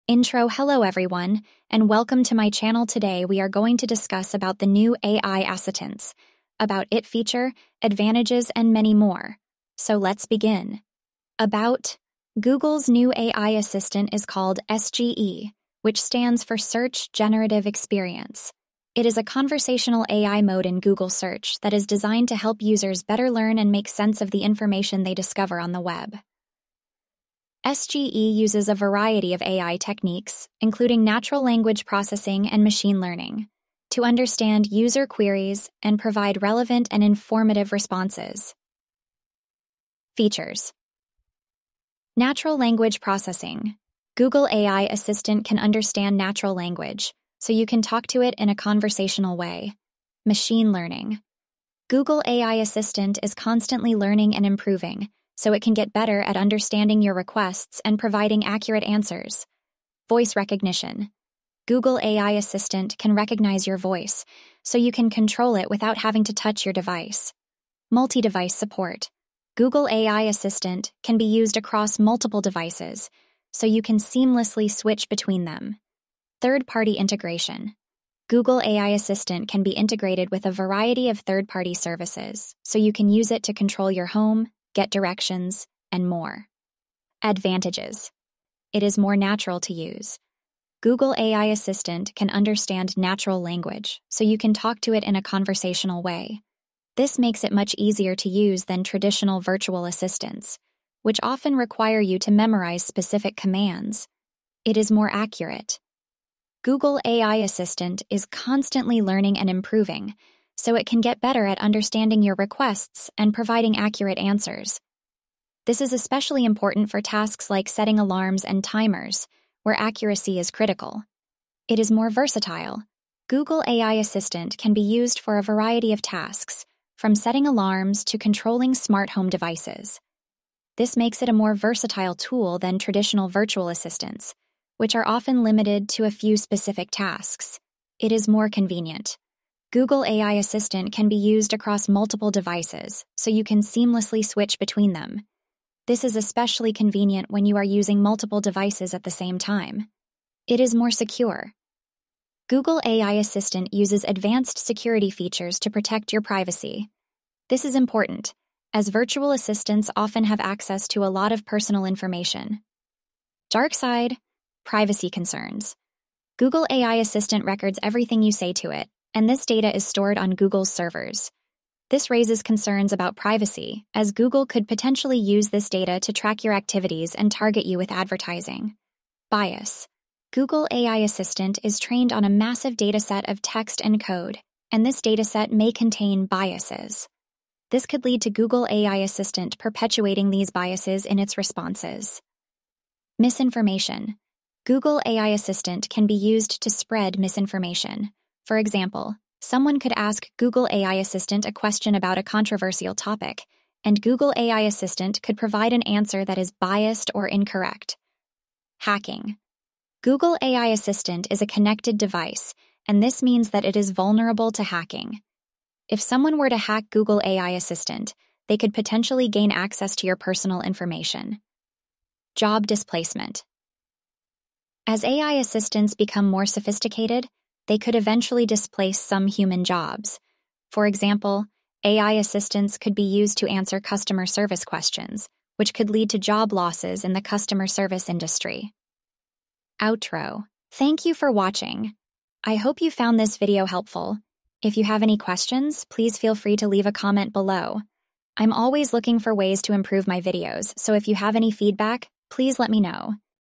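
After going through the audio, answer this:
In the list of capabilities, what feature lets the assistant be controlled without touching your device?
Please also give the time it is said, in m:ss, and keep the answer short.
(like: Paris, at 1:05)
Voice recognition, at 1:00.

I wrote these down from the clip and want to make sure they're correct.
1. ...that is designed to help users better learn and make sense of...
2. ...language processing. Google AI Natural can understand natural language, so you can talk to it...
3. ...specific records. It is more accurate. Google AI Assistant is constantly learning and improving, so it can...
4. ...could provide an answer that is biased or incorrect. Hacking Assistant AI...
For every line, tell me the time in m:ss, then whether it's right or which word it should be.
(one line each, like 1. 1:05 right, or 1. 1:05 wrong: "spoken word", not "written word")
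1. 0:21 right
2. 0:42 wrong: "Assistant", not "Natural"
3. 1:42 wrong: "commands", not "records"
4. 3:25 wrong: "Google", not "Assistant".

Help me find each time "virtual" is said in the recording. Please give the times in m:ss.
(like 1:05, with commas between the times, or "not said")
1:39, 2:13, 2:38.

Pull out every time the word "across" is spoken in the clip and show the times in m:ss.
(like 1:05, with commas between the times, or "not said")
1:11, 2:21.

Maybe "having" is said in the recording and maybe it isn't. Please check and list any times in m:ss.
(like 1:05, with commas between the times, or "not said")
1:05.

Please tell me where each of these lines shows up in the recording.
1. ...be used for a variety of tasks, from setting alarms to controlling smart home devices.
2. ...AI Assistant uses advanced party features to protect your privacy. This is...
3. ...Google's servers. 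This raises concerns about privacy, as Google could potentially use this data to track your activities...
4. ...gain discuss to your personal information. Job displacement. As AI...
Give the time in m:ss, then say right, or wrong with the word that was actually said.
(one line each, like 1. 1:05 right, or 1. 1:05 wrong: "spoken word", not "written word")
1. 2:04 right
2. 2:32 wrong: "security", not "party"
3. 2:50 right
4. 3:39 wrong: "access", not "discuss".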